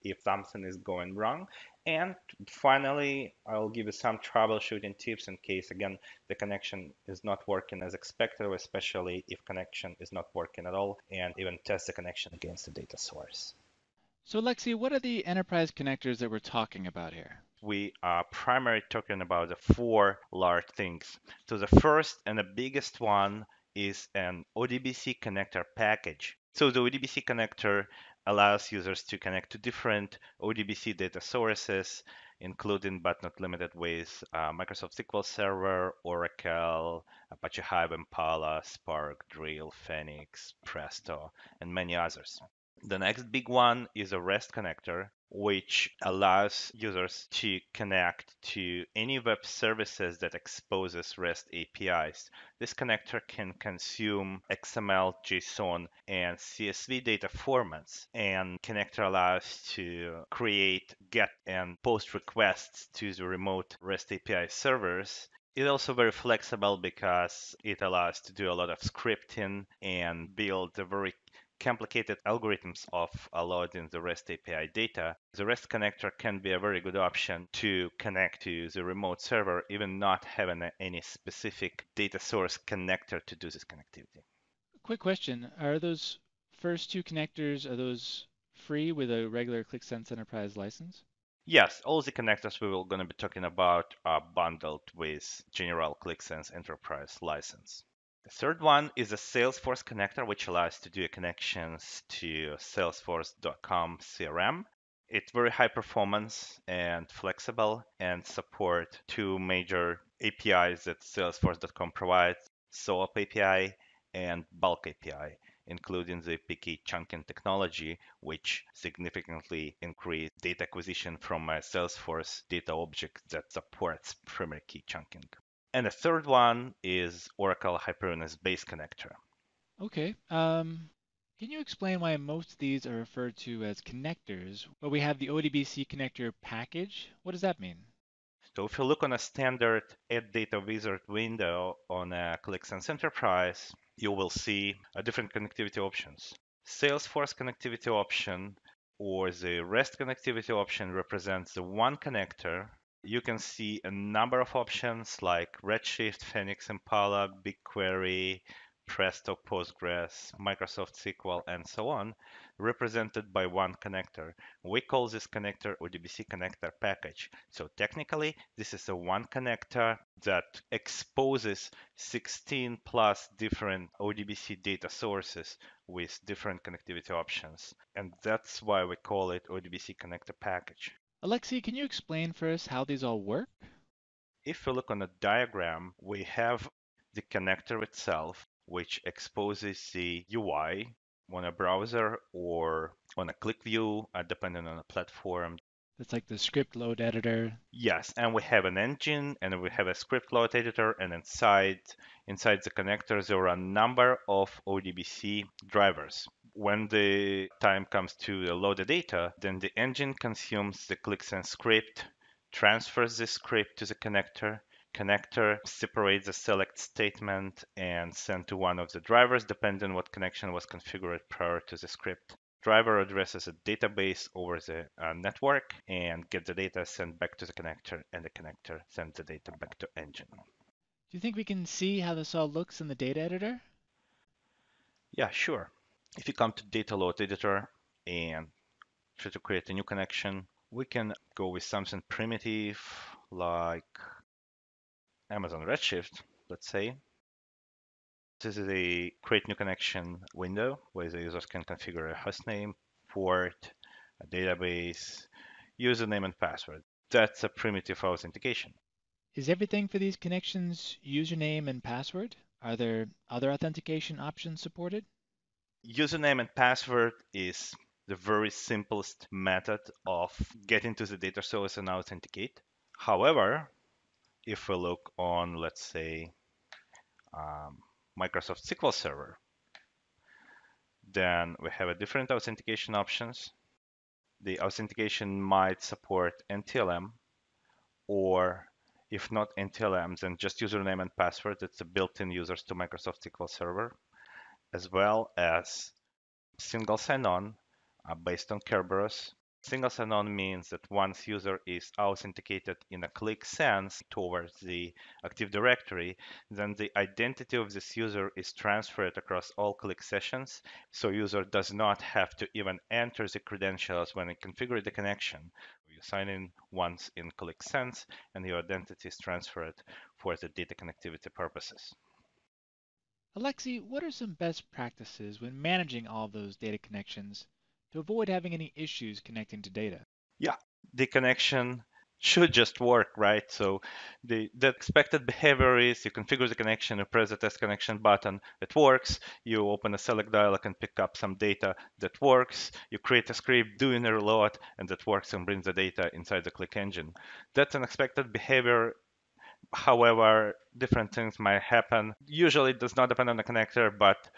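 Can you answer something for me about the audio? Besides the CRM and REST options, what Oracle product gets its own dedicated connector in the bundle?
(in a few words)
Oracle Hyperion Essbase.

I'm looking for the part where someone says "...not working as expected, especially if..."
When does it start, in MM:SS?
00:07.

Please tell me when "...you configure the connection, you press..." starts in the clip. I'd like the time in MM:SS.
05:36.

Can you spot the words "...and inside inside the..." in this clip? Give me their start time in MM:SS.
03:21.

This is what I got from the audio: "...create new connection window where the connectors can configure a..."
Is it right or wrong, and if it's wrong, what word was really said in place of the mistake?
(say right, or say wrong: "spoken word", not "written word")
wrong: "users", not "connectors".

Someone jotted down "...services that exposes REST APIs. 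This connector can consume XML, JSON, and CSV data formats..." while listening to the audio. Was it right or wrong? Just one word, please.
right.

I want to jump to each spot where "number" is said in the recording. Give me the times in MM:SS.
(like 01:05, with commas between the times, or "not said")
02:33, 03:23.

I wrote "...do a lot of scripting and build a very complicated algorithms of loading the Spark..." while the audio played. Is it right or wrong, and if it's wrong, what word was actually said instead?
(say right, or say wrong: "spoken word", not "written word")
wrong: "REST", not "Spark".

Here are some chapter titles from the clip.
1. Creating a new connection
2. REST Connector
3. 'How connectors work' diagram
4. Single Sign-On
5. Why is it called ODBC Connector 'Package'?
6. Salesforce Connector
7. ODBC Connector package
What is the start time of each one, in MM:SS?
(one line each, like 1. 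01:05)
1. 03:56
2. 00:42
3. 03:02
4. 04:53
5. 02:16
6. 01:38
7. 00:16.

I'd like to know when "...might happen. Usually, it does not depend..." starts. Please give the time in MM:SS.
05:51.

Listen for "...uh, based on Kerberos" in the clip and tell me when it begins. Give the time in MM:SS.
04:58.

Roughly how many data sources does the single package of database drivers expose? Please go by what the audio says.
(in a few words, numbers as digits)
16 plus.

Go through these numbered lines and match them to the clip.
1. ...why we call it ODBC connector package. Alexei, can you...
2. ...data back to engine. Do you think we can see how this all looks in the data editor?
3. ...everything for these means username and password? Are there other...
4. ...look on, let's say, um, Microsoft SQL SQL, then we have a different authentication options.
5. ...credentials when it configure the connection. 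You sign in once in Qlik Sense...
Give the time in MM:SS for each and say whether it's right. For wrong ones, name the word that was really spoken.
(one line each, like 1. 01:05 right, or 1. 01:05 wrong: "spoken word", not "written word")
1. 02:58 right
2. 03:49 right
3. 04:19 wrong: "connections", not "means"
4. 04:34 wrong: "Server", not "SQL"
5. 05:13 right.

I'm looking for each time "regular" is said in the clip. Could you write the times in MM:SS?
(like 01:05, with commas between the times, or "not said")
01:29.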